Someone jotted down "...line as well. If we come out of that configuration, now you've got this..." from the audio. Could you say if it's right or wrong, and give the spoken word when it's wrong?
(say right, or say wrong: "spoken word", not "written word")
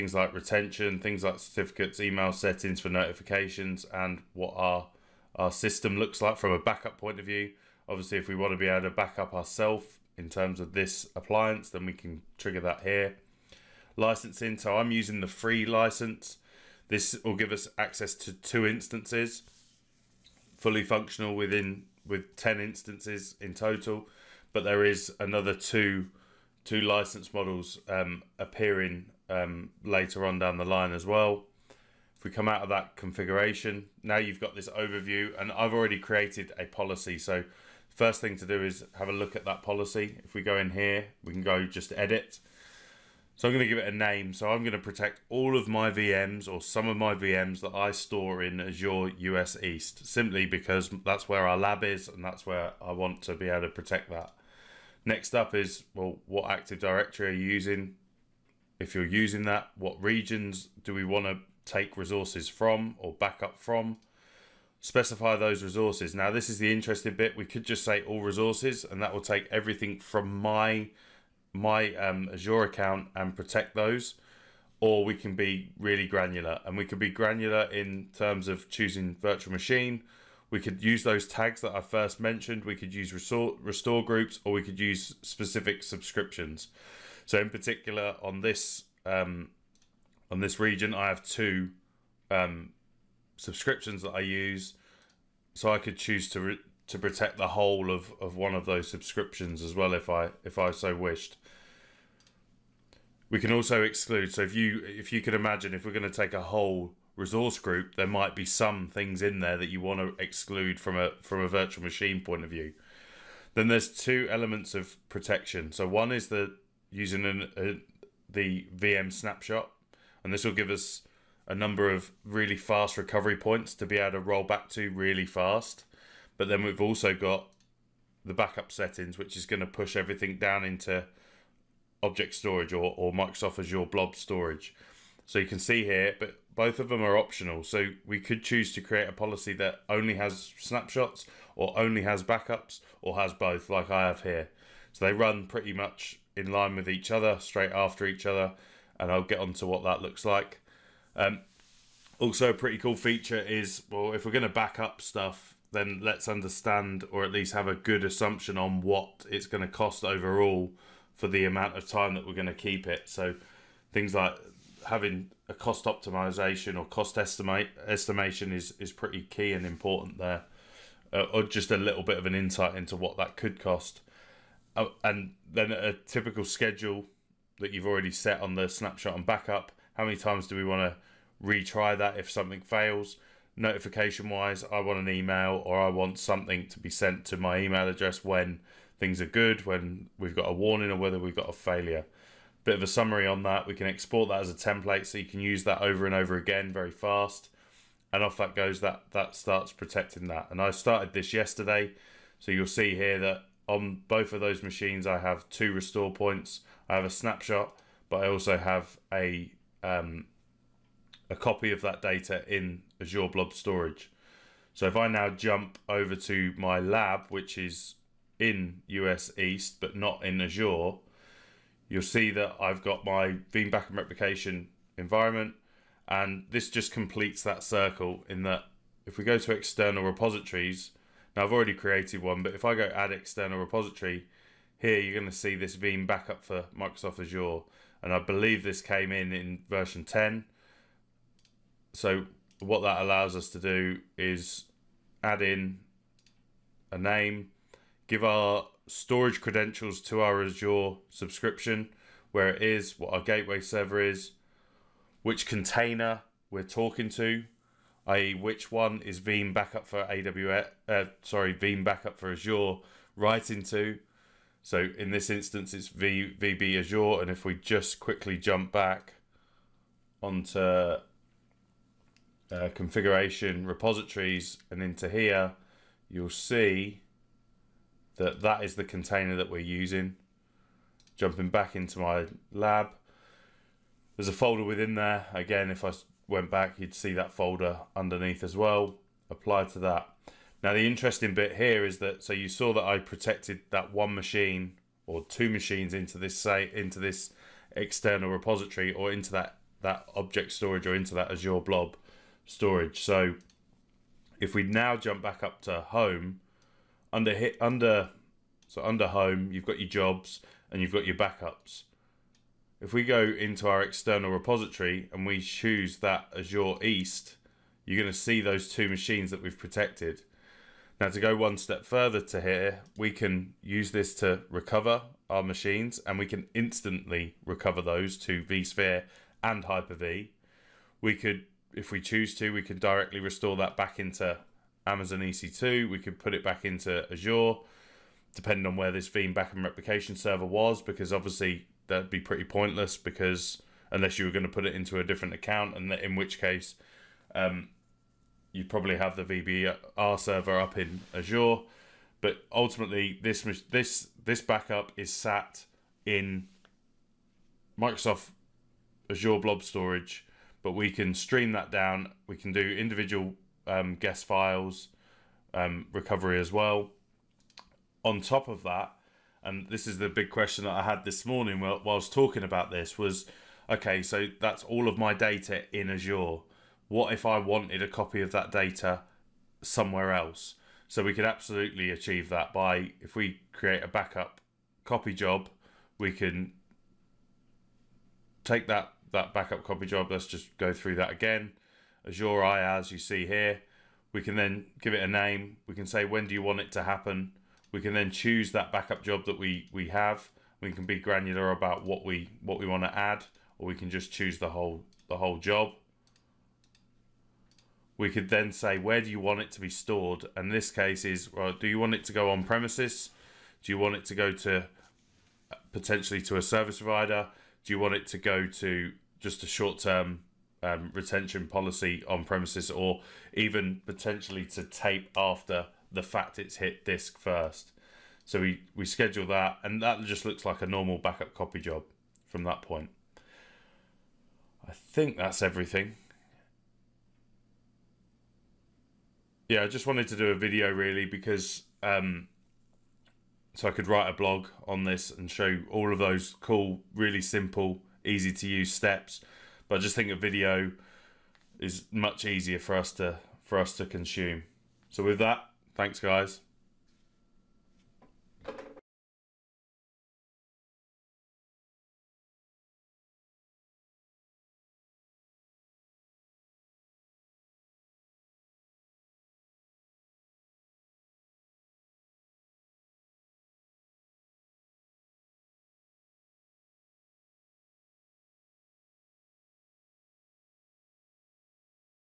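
right.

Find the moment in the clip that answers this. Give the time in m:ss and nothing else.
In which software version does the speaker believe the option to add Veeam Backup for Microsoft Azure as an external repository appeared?
3:59.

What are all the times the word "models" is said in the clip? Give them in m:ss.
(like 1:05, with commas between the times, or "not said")
0:27.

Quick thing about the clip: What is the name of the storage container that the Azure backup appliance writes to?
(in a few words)
VB Azure.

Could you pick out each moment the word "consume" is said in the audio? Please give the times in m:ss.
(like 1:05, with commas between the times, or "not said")
7:33.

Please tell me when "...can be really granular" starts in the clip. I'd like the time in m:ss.
1:15.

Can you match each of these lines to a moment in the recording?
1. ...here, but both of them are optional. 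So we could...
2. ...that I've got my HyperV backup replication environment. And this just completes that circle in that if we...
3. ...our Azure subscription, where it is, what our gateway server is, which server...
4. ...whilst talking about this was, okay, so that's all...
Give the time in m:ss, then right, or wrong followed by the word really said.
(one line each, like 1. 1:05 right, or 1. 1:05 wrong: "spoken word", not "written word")
1. 2:15 right
2. 3:42 wrong: "Veeam", not "HyperV"
3. 4:10 wrong: "container", not "server"
4. 6:11 right.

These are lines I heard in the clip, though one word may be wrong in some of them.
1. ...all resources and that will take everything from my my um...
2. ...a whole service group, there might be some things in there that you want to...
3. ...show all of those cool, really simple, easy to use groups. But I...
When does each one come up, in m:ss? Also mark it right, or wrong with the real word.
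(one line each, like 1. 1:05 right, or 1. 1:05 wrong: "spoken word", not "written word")
1. 1:08 right
2. 1:46 wrong: "resource", not "service"
3. 7:25 wrong: "steps", not "groups".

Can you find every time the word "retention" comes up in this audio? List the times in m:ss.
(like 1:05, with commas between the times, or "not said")
0:00, 7:00.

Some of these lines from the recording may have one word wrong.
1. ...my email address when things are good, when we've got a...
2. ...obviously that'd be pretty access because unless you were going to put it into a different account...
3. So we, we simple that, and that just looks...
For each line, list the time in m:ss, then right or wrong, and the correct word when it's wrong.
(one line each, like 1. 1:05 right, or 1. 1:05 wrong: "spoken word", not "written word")
1. 3:07 right
2. 5:41 wrong: "pointless", not "access"
3. 7:08 wrong: "schedule", not "simple".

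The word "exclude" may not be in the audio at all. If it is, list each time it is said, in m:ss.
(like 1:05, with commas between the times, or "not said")
1:43, 1:50.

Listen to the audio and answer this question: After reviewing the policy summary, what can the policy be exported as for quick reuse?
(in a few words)
A template.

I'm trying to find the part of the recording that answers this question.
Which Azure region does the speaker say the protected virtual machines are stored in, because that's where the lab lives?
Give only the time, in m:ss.
0:48.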